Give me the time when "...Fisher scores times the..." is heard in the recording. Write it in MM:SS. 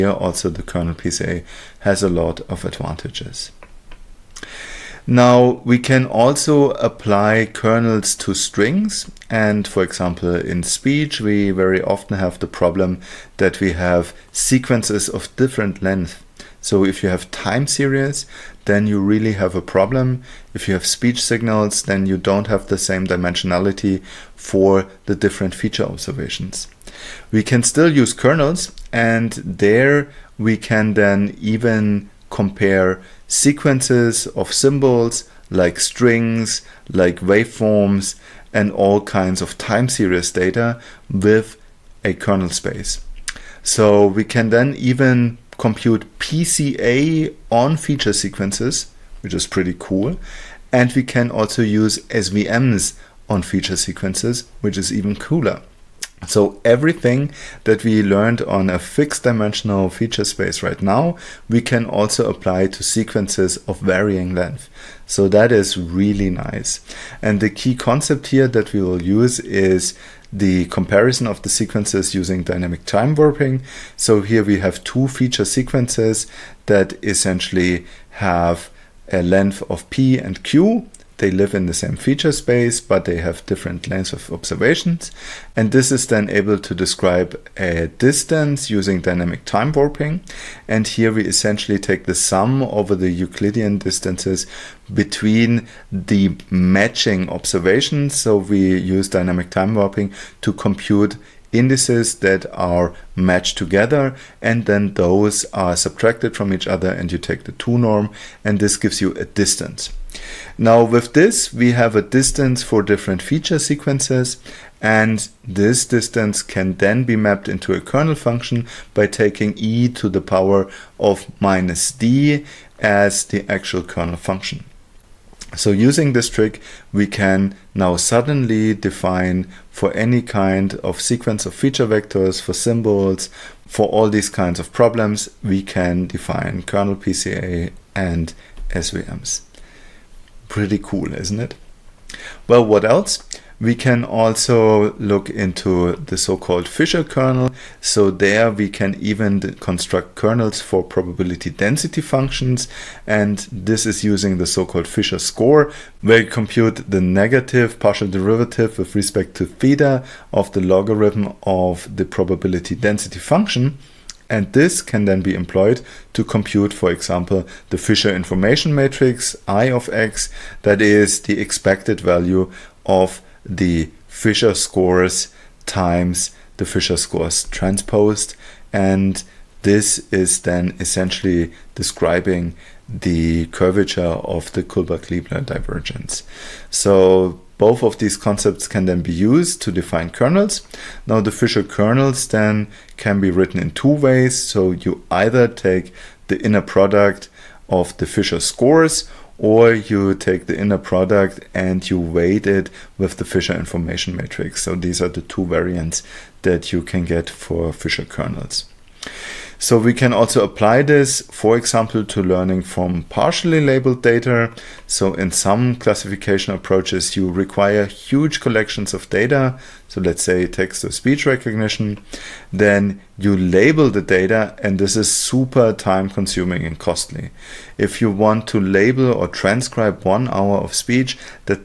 02:54.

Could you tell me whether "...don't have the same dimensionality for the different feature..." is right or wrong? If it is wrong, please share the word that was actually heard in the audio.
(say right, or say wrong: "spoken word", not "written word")
right.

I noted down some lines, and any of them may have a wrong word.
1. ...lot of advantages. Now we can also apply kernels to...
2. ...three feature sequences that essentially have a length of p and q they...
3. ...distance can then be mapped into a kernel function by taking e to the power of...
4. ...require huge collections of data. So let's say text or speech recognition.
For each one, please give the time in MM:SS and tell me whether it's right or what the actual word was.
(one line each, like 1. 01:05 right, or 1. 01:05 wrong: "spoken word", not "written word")
1. 00:02 right
2. 01:14 wrong: "two", not "three"
3. 01:55 right
4. 03:37 right.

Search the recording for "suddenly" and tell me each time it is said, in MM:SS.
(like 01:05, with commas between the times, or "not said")
02:07.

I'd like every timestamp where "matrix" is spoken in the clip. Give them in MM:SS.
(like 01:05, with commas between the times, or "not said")
02:48, 03:24.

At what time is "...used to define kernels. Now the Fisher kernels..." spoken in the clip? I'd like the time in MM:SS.
03:09.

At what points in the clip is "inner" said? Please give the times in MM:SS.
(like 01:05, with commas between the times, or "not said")
03:16, 03:20.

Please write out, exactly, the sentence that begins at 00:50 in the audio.
And we can also use SVMs on feature sequences, which is even cooler.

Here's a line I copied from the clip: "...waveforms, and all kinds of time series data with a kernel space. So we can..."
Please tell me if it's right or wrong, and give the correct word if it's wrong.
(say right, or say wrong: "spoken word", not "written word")
right.